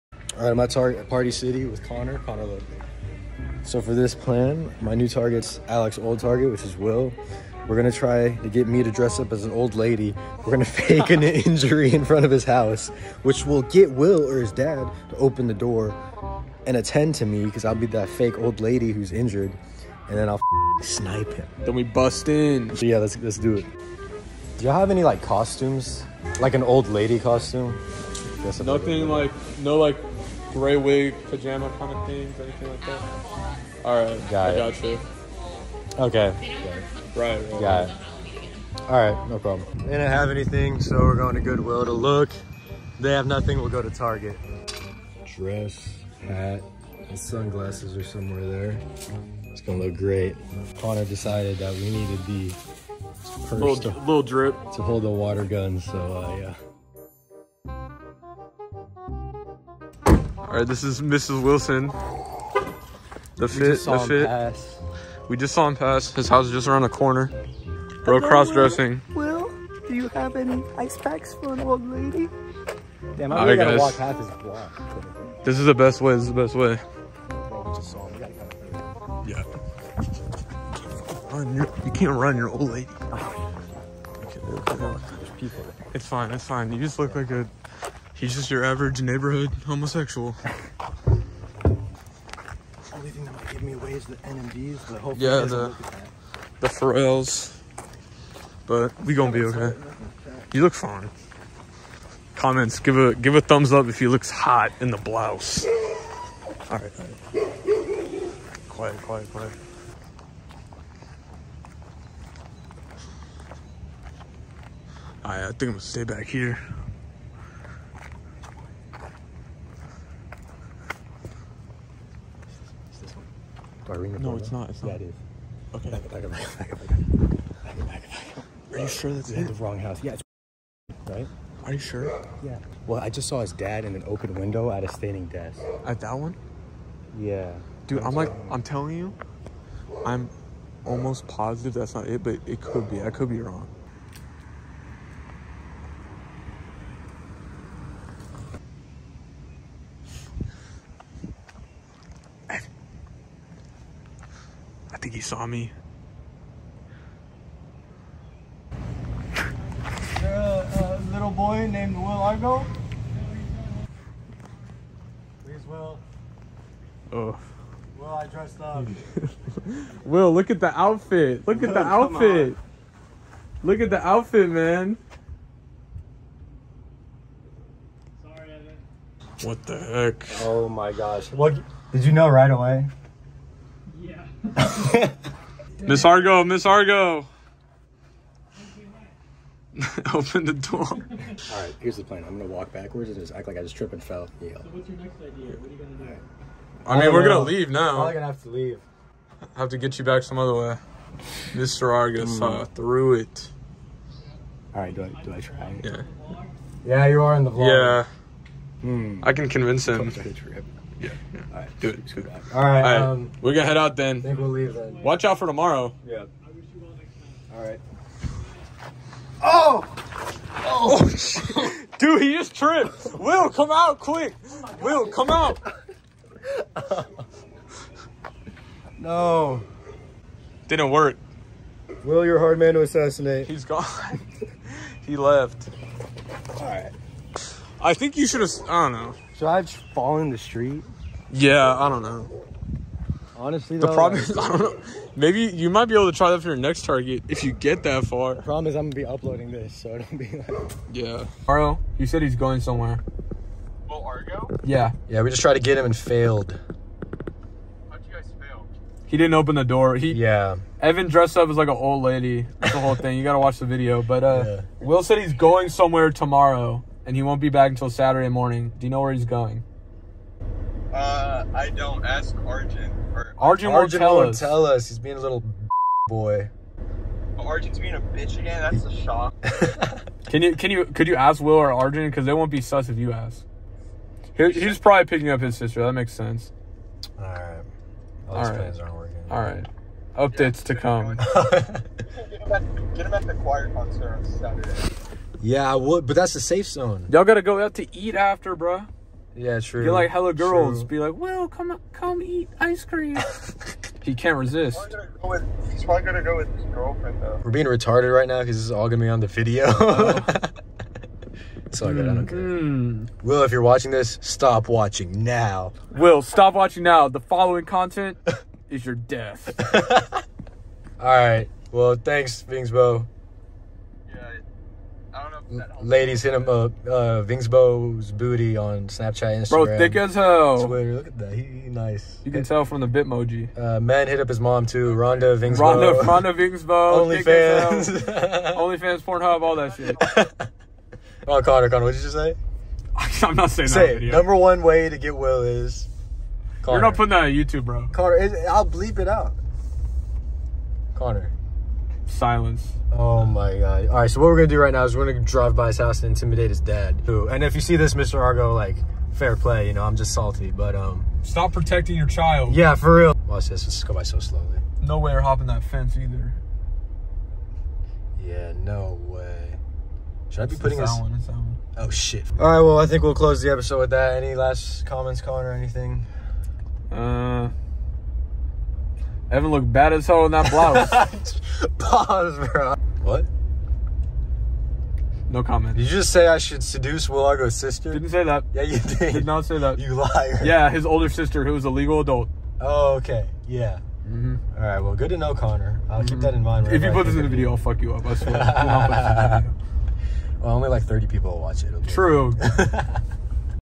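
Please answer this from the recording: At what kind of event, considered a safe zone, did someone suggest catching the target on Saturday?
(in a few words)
choir concert.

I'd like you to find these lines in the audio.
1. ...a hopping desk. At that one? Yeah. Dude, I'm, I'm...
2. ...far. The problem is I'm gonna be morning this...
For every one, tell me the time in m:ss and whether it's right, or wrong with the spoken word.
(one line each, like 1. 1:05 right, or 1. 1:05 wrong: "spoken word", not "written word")
1. 2:14 wrong: "standing", not "hopping"
2. 4:08 wrong: "uploading", not "morning".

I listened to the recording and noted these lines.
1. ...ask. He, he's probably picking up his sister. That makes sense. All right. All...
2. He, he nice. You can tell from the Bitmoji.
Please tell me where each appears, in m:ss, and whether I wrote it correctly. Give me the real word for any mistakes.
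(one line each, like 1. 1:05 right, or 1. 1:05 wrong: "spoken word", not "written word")
1. 4:43 right
2. 5:31 right.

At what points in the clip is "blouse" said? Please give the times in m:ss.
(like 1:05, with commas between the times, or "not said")
1:44, 6:20.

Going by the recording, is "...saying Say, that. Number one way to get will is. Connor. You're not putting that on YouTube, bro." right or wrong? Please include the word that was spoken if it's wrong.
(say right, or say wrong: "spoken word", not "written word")
right.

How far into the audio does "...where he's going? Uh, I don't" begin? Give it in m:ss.
4:29.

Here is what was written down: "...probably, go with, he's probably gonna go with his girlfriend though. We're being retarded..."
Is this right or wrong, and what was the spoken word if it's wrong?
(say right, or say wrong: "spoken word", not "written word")
right.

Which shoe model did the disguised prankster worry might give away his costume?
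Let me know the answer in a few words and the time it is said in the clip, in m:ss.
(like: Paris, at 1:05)
NMDs, at 1:34.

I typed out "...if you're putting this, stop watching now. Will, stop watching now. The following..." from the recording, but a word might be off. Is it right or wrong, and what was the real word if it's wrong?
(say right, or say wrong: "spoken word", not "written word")
wrong: "watching", not "putting".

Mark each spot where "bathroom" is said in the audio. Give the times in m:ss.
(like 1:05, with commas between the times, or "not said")
not said.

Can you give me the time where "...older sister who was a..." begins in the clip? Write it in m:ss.
6:30.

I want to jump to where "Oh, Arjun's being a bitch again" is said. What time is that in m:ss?
4:37.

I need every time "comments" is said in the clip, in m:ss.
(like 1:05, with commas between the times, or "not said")
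1:42, 6:14, 6:25.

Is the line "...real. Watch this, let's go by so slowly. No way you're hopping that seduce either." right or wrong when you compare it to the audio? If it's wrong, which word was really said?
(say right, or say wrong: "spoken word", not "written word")
wrong: "fence", not "seduce".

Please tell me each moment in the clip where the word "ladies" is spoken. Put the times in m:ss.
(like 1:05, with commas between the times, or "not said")
5:25.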